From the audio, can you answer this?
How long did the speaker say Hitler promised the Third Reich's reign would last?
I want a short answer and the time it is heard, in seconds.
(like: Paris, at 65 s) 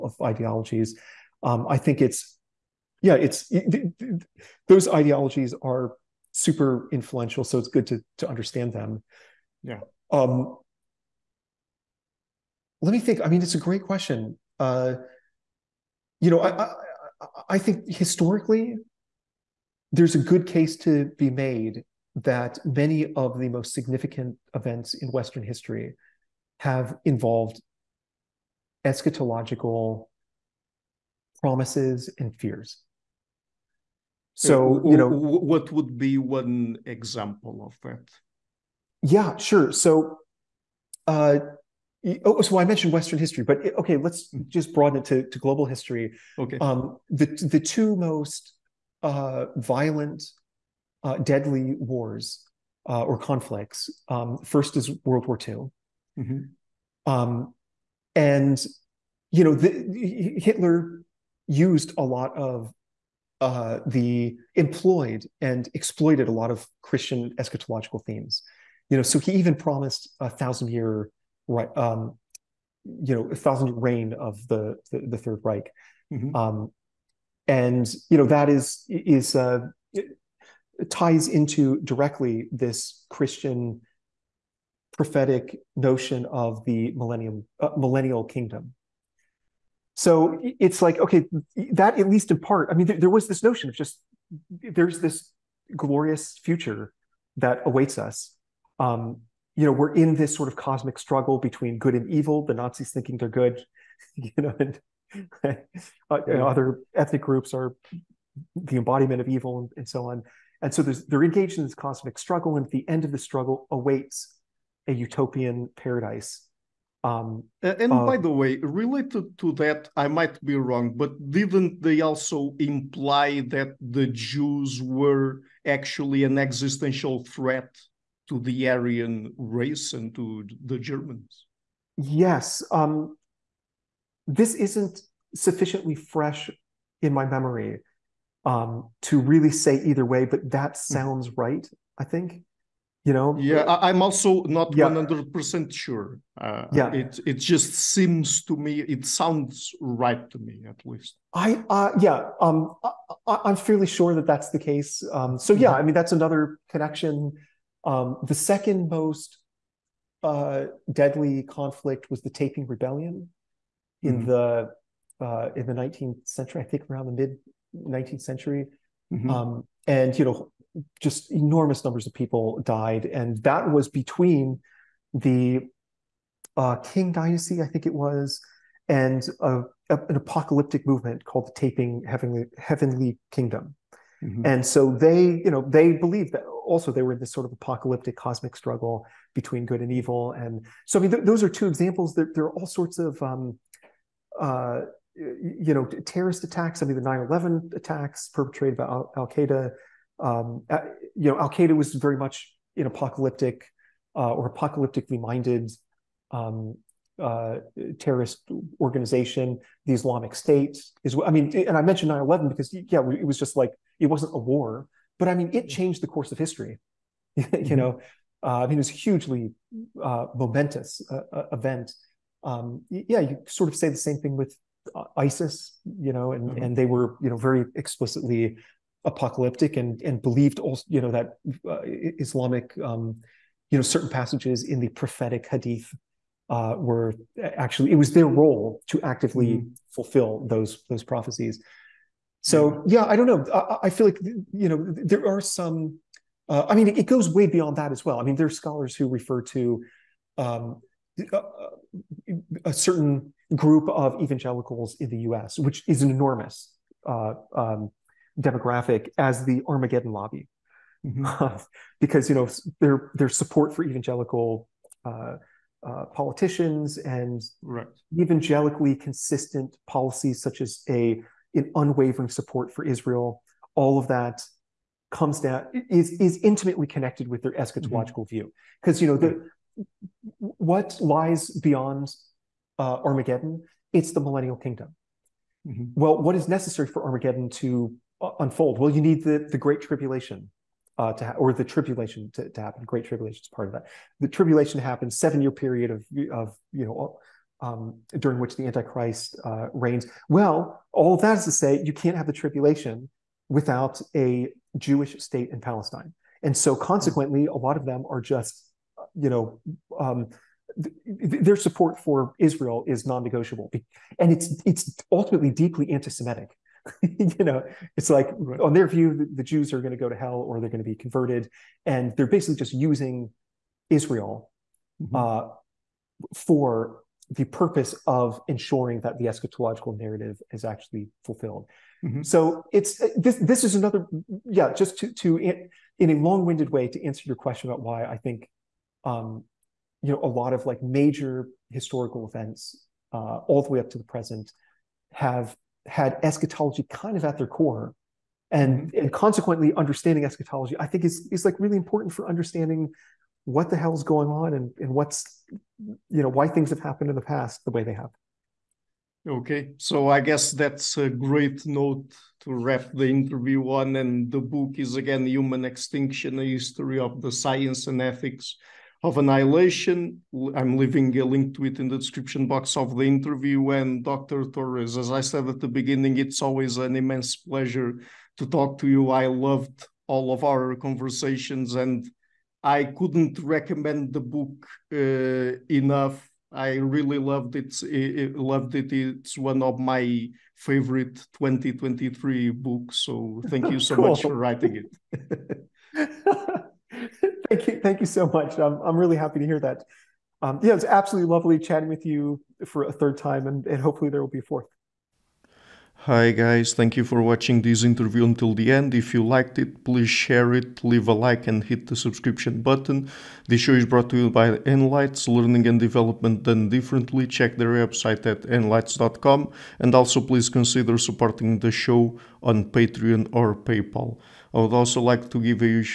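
1000 years, at 70 s.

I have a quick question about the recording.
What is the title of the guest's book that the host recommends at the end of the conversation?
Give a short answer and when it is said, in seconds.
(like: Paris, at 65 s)
Human Extinction, at 365 s.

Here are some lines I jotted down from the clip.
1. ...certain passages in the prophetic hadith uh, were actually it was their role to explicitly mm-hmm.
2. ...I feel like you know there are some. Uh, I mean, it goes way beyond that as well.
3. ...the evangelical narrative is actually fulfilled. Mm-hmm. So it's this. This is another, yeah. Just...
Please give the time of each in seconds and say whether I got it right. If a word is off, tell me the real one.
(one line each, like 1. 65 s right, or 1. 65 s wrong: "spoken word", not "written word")
1. 233 s wrong: "actively", not "explicitly"
2. 243 s right
3. 329 s wrong: "eschatological", not "evangelical".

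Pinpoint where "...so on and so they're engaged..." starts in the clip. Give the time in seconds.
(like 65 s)
109 s.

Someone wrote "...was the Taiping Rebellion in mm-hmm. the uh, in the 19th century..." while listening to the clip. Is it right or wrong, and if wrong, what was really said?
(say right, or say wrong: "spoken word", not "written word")
right.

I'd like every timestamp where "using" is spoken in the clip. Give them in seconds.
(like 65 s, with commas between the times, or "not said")
322 s.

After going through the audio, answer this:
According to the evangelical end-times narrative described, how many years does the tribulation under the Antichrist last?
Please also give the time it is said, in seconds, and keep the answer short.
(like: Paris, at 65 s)
7, at 295 s.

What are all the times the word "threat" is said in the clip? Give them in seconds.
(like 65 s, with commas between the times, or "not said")
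127 s.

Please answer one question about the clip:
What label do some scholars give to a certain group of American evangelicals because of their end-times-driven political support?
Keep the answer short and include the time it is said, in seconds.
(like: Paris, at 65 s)
Armageddon lobby, at 259 s.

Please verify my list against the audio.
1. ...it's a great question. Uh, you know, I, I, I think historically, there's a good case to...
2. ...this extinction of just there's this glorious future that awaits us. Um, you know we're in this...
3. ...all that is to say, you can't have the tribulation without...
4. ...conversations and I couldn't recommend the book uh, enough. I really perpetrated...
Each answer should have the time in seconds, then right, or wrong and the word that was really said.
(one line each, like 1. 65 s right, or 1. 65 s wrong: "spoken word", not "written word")
1. 13 s right
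2. 93 s wrong: "notion", not "extinction"
3. 300 s right
4. 380 s wrong: "loved", not "perpetrated".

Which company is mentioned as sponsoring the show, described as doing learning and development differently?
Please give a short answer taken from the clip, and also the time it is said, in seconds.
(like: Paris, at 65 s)
Enlites, at 414 s.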